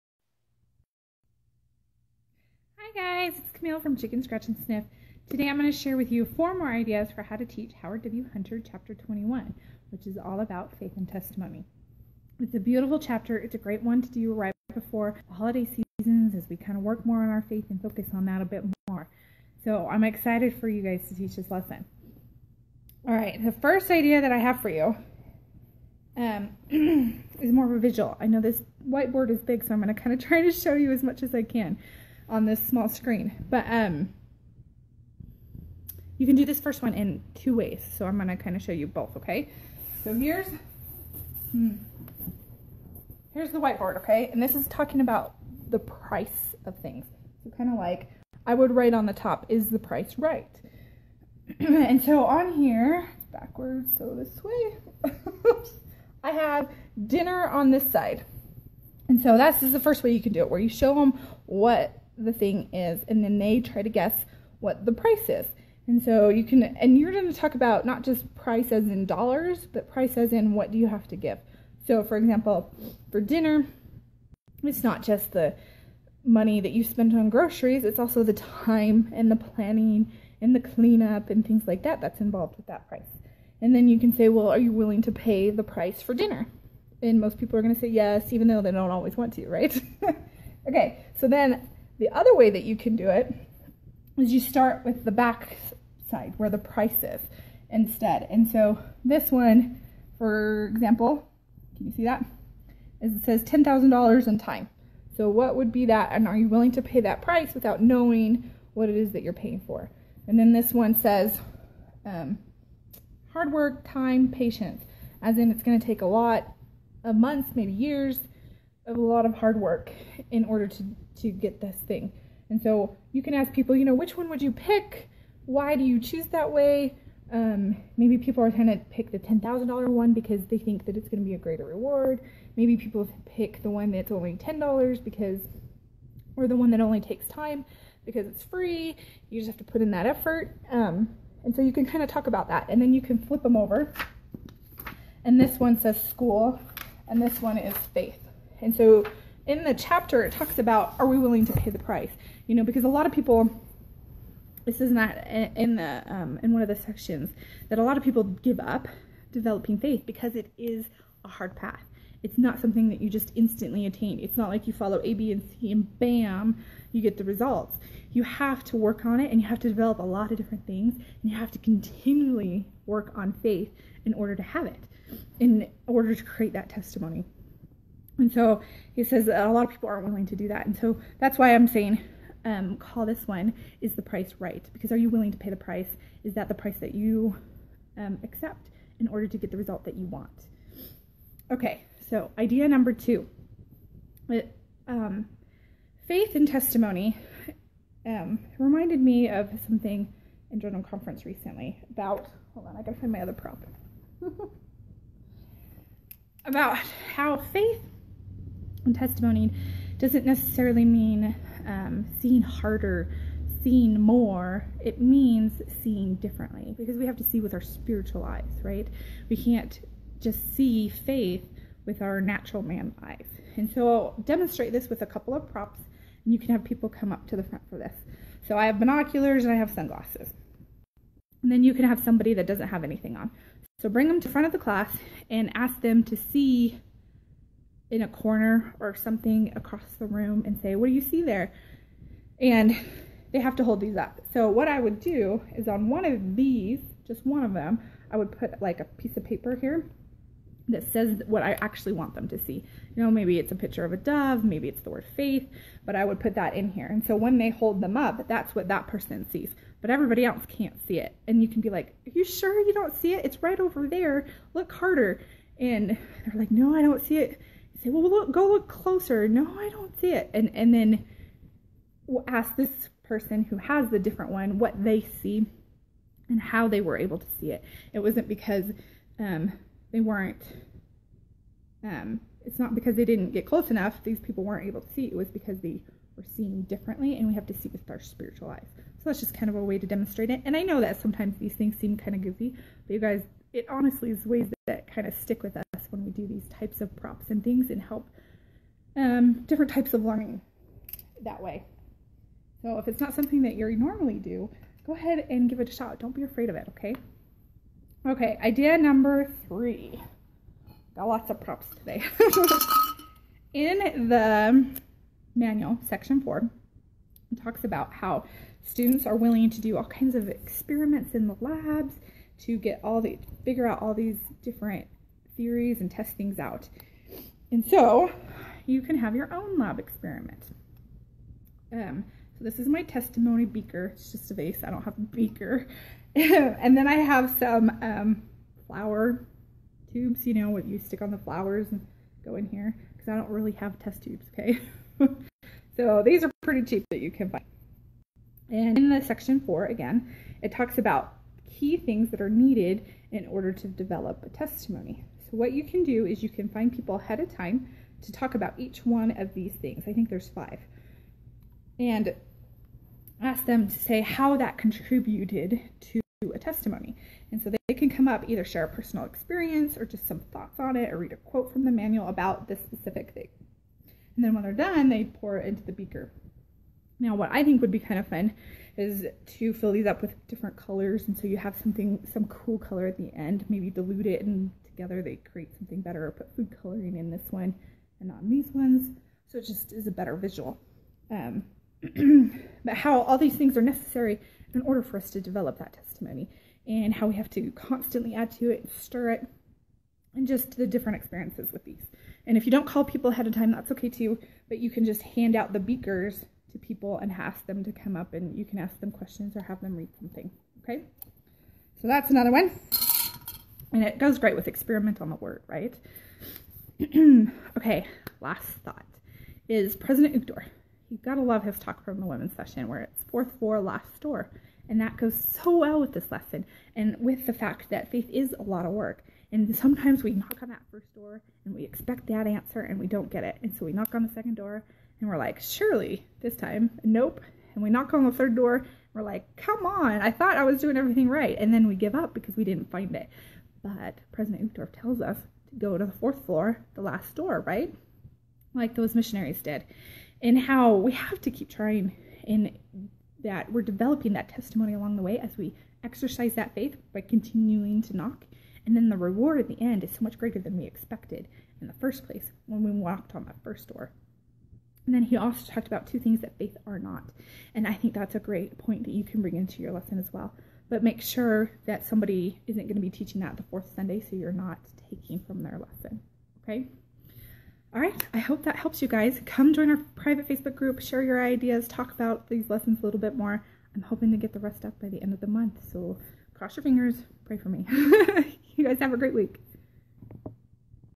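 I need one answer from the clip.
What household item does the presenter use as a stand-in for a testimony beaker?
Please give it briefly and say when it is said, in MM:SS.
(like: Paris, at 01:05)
A vase, at 05:34.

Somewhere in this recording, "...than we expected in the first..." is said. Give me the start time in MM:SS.
07:40.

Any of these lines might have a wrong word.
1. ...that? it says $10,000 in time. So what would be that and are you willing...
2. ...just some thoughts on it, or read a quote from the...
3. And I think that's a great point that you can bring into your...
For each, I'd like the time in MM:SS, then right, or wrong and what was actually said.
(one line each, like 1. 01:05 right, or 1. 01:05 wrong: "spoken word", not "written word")
1. 01:42 right
2. 06:09 right
3. 07:47 right.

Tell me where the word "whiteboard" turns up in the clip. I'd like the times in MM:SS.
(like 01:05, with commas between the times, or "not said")
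00:28, 00:43.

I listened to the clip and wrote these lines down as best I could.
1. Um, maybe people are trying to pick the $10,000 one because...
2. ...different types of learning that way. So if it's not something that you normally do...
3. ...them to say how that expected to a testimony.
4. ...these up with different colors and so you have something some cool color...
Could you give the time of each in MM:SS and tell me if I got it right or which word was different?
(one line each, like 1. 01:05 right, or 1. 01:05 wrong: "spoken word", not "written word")
1. 02:07 right
2. 04:59 right
3. 06:03 wrong: "contributed", not "expected"
4. 06:19 right.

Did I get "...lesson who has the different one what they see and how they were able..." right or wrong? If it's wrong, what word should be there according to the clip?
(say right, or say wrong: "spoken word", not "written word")
wrong: "person", not "lesson".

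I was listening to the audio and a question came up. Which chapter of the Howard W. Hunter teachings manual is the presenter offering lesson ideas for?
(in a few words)
Chapter 21.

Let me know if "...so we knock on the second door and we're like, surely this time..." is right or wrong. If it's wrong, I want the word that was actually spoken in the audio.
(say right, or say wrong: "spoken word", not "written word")
right.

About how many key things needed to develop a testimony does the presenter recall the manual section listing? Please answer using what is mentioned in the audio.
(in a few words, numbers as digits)
5.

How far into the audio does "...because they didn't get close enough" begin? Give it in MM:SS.
04:42.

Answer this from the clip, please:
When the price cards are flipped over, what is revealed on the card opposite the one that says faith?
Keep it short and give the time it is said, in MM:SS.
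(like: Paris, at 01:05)
School, at 02:26.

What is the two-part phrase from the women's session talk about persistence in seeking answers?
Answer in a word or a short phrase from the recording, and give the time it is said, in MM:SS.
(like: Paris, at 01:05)
Fourth floor, last door, at 07:03.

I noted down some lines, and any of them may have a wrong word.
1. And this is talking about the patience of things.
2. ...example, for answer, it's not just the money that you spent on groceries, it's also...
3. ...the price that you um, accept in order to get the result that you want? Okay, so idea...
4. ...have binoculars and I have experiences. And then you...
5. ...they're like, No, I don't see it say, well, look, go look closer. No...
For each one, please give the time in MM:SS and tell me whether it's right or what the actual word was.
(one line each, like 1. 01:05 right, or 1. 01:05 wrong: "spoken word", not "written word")
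1. 00:44 wrong: "price", not "patience"
2. 01:12 wrong: "dinner", not "answer"
3. 03:06 right
4. 03:48 wrong: "sunglasses", not "experiences"
5. 04:25 right.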